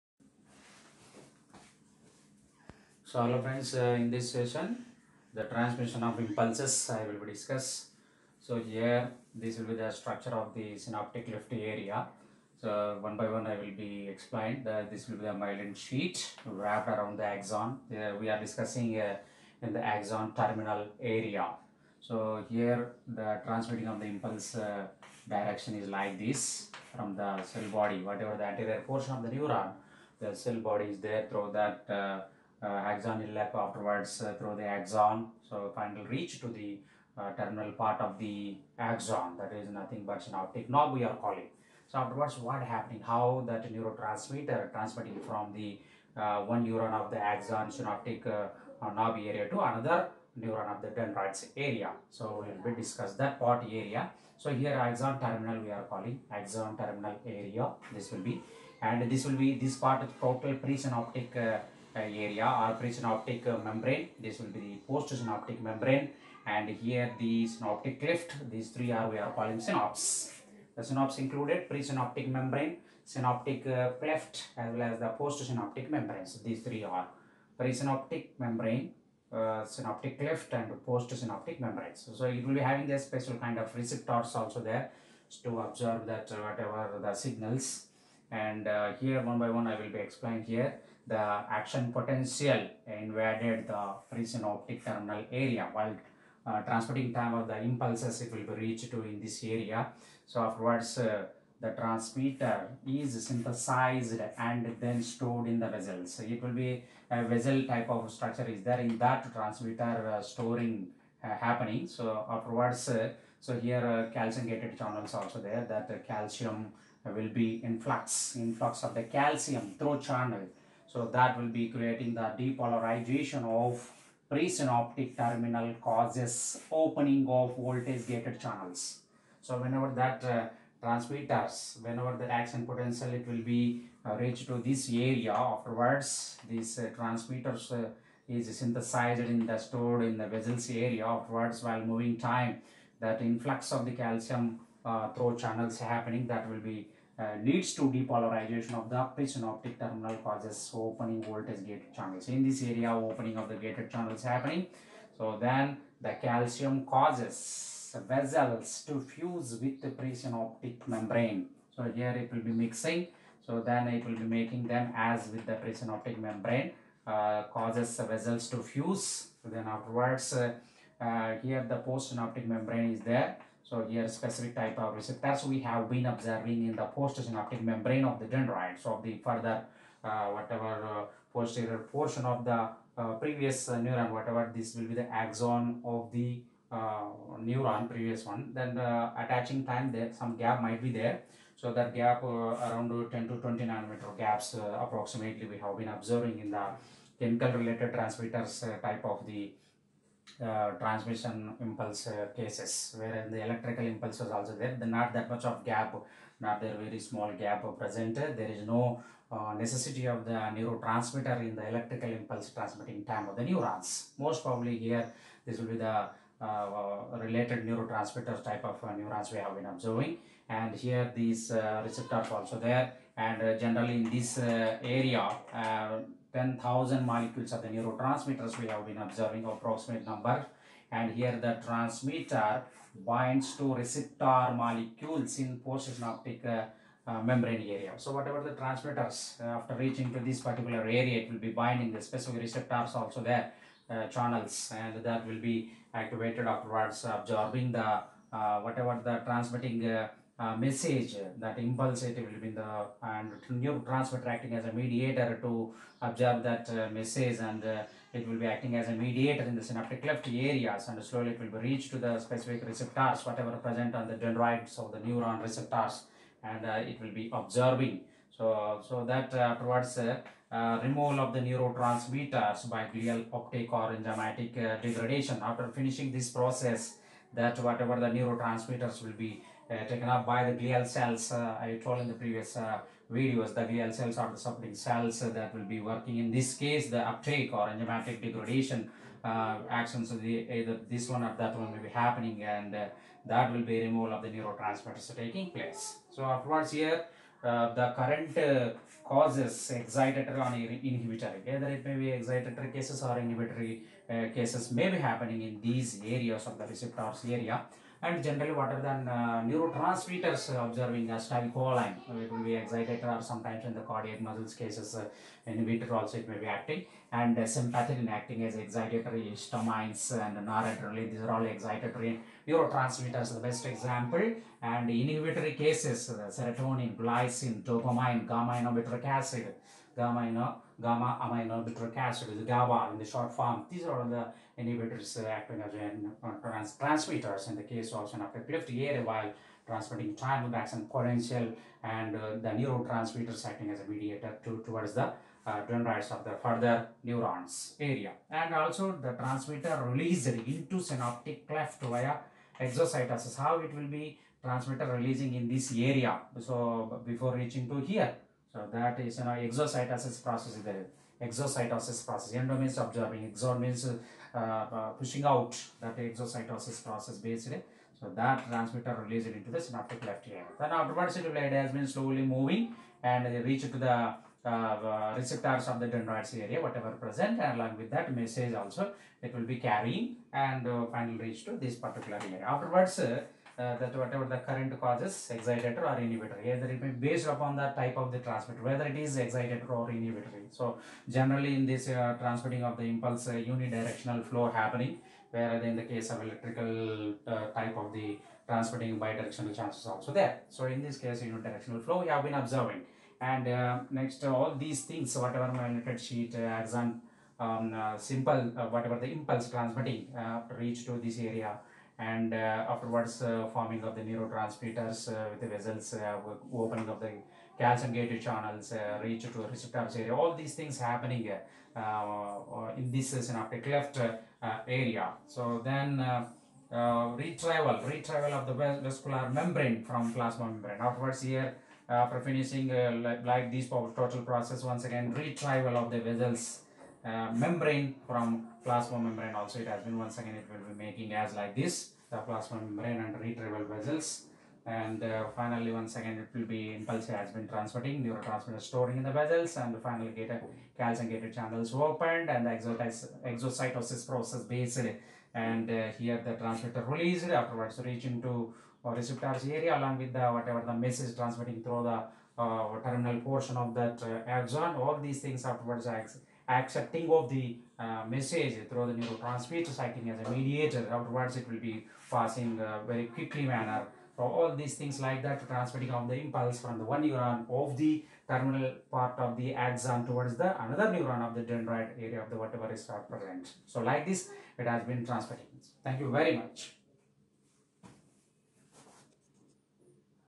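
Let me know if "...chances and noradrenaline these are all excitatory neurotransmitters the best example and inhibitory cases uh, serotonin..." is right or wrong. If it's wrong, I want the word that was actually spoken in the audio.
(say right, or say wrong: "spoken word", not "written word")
wrong: "histamines", not "chances".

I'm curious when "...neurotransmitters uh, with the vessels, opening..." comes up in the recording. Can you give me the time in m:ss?
6:54.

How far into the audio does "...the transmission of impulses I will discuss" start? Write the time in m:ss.
0:05.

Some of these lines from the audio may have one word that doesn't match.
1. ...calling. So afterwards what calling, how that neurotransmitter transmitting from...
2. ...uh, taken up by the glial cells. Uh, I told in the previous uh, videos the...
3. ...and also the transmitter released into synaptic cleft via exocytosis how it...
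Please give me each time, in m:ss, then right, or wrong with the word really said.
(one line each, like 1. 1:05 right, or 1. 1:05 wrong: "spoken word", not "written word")
1. 0:41 wrong: "happening", not "calling"
2. 4:39 right
3. 5:48 right.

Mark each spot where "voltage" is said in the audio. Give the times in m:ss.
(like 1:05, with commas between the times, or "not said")
2:07, 2:31.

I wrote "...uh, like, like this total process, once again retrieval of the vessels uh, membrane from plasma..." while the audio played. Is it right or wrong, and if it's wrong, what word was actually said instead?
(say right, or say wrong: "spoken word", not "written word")
right.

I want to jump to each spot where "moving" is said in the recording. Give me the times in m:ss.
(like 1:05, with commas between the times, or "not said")
2:21, 6:12.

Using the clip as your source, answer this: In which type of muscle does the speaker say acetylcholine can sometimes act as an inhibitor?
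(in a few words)
cardiac muscles.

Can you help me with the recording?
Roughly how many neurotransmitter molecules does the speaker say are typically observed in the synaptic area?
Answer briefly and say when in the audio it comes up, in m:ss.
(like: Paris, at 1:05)
10,000, at 3:46.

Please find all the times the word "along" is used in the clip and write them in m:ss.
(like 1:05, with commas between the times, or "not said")
6:17, 7:39.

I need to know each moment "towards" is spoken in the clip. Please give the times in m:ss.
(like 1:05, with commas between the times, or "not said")
4:29, 5:44, 8:00.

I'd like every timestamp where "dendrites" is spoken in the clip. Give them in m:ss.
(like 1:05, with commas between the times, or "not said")
0:50, 2:58, 4:24, 5:45, 6:15, 8:01.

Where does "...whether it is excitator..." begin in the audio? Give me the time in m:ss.
6:28.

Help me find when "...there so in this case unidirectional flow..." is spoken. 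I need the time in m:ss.
6:40.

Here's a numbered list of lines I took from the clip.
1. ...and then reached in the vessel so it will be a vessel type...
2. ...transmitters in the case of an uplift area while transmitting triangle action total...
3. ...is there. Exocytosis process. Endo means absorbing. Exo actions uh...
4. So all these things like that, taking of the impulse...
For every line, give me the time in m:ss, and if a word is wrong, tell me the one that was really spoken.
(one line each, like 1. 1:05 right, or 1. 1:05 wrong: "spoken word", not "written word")
1. 1:44 wrong: "stored", not "reached"
2. 5:36 wrong: "potential", not "total"
3. 6:00 wrong: "means", not "actions"
4. 7:54 wrong: "transmitting", not "taking".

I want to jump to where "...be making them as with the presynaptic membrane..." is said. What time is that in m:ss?
2:44.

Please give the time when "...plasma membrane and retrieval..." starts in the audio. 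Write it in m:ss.
7:22.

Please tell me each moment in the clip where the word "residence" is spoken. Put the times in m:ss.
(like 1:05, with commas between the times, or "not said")
not said.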